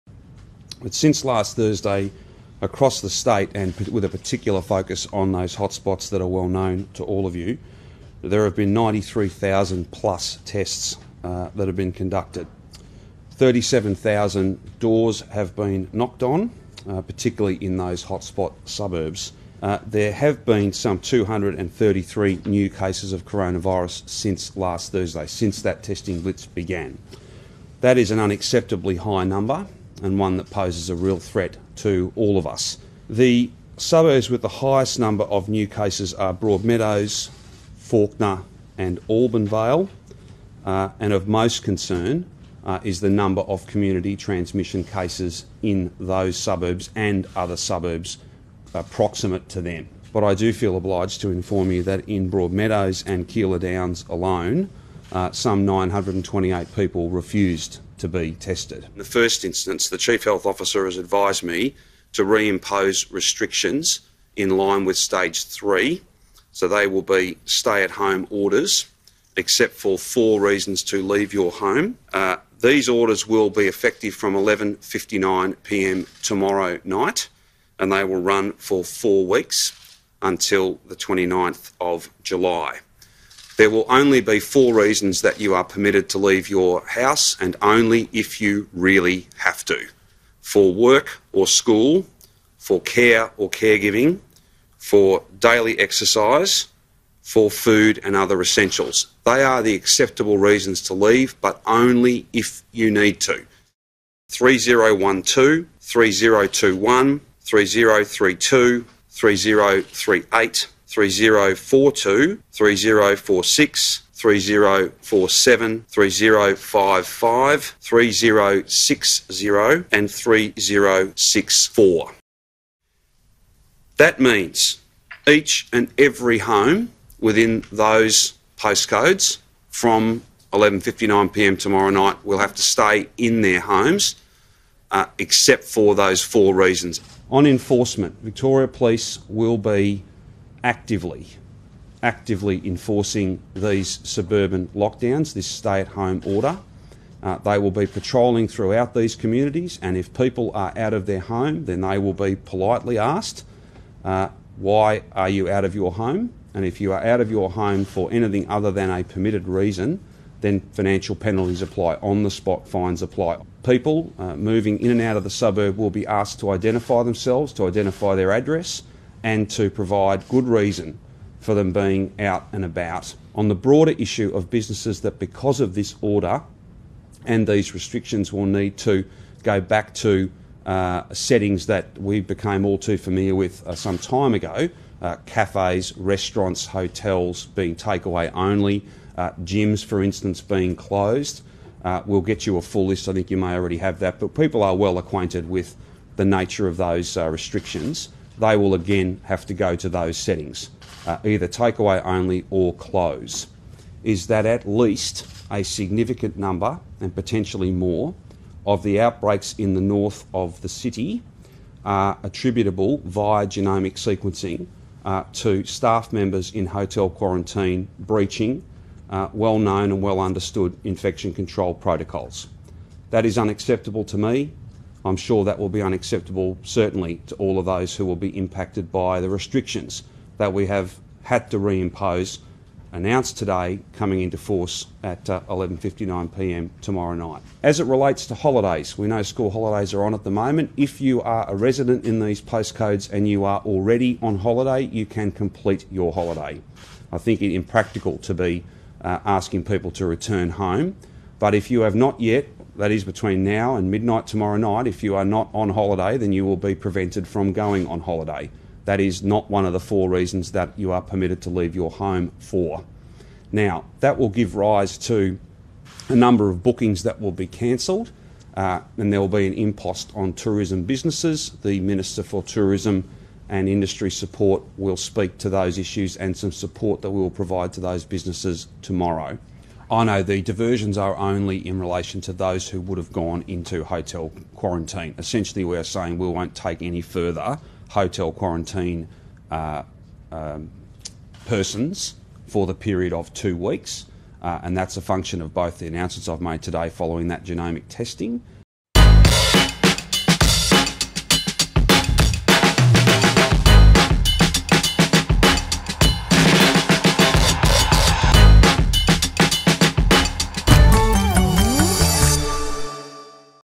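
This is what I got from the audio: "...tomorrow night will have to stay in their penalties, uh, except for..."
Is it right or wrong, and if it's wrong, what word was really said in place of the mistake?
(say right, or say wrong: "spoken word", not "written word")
wrong: "homes", not "penalties".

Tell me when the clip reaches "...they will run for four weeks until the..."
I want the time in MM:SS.
01:17.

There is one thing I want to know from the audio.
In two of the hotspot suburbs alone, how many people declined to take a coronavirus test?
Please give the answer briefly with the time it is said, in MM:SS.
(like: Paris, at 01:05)
928, at 00:55.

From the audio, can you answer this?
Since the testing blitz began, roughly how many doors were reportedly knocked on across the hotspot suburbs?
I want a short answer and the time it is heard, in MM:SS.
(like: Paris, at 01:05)
37,000, at 00:13.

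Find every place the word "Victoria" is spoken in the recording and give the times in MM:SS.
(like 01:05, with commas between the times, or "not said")
02:18.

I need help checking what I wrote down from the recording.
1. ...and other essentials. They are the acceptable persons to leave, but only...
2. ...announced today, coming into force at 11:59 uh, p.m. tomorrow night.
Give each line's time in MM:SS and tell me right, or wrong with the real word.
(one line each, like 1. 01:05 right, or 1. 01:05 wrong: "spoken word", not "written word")
1. 01:38 wrong: "reasons", not "persons"
2. 03:52 right.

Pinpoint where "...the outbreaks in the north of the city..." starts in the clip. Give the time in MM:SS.
03:28.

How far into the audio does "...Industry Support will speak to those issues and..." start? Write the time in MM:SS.
04:33.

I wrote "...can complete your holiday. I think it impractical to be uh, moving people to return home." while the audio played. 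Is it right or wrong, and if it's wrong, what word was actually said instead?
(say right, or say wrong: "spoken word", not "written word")
wrong: "asking", not "moving".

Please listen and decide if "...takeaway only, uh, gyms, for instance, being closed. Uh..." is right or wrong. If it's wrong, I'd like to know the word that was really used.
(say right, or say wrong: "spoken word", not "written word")
right.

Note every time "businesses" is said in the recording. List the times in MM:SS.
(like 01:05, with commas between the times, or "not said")
02:54, 04:30, 04:38.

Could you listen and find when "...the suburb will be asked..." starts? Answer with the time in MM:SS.
02:45.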